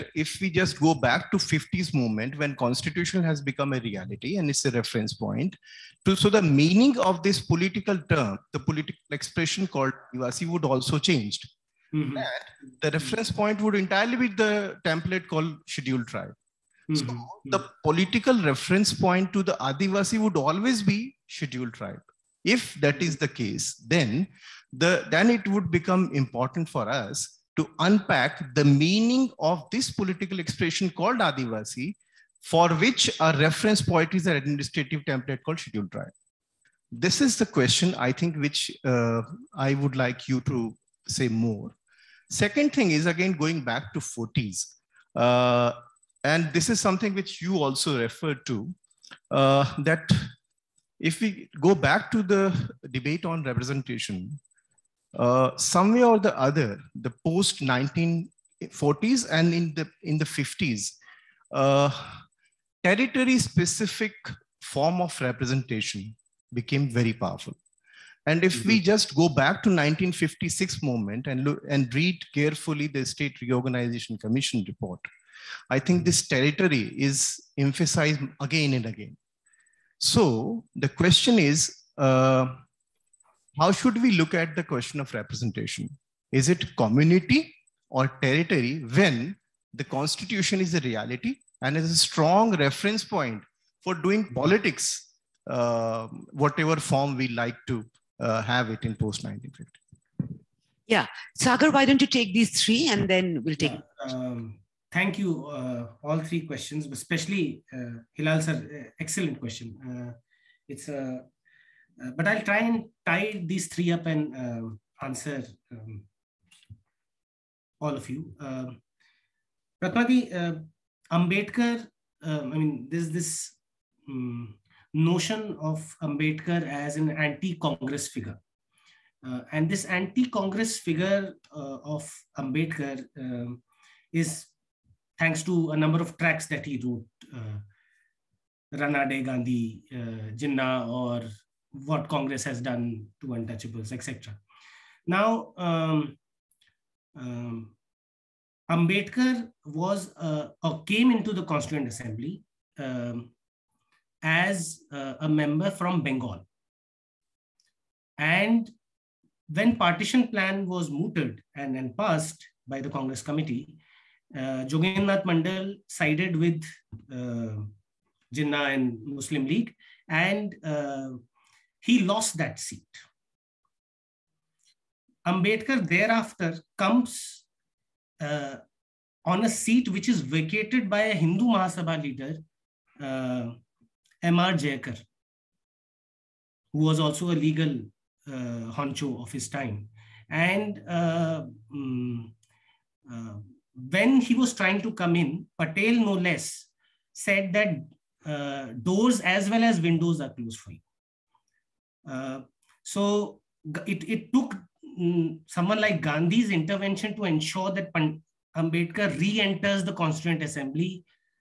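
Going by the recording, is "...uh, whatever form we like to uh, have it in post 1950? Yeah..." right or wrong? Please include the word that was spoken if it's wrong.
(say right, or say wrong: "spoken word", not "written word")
right.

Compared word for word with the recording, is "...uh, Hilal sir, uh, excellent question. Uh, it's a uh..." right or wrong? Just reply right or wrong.
right.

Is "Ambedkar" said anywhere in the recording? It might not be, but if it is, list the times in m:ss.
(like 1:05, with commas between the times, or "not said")
2:01, 2:06, 2:12, 2:28, 2:55, 3:28.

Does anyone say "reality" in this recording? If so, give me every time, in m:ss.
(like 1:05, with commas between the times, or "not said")
0:03, 1:30.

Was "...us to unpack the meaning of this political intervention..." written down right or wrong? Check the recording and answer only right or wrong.
wrong.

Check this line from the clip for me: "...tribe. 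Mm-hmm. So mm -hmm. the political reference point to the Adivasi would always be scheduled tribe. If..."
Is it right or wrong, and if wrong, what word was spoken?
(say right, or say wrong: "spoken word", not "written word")
right.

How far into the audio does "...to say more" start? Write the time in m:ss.
0:40.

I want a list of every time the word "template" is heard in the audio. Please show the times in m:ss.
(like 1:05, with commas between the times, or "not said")
0:14, 0:35.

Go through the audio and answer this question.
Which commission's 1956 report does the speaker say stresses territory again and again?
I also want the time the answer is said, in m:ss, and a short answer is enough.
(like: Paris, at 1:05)
State Reorganization Commission, at 1:13.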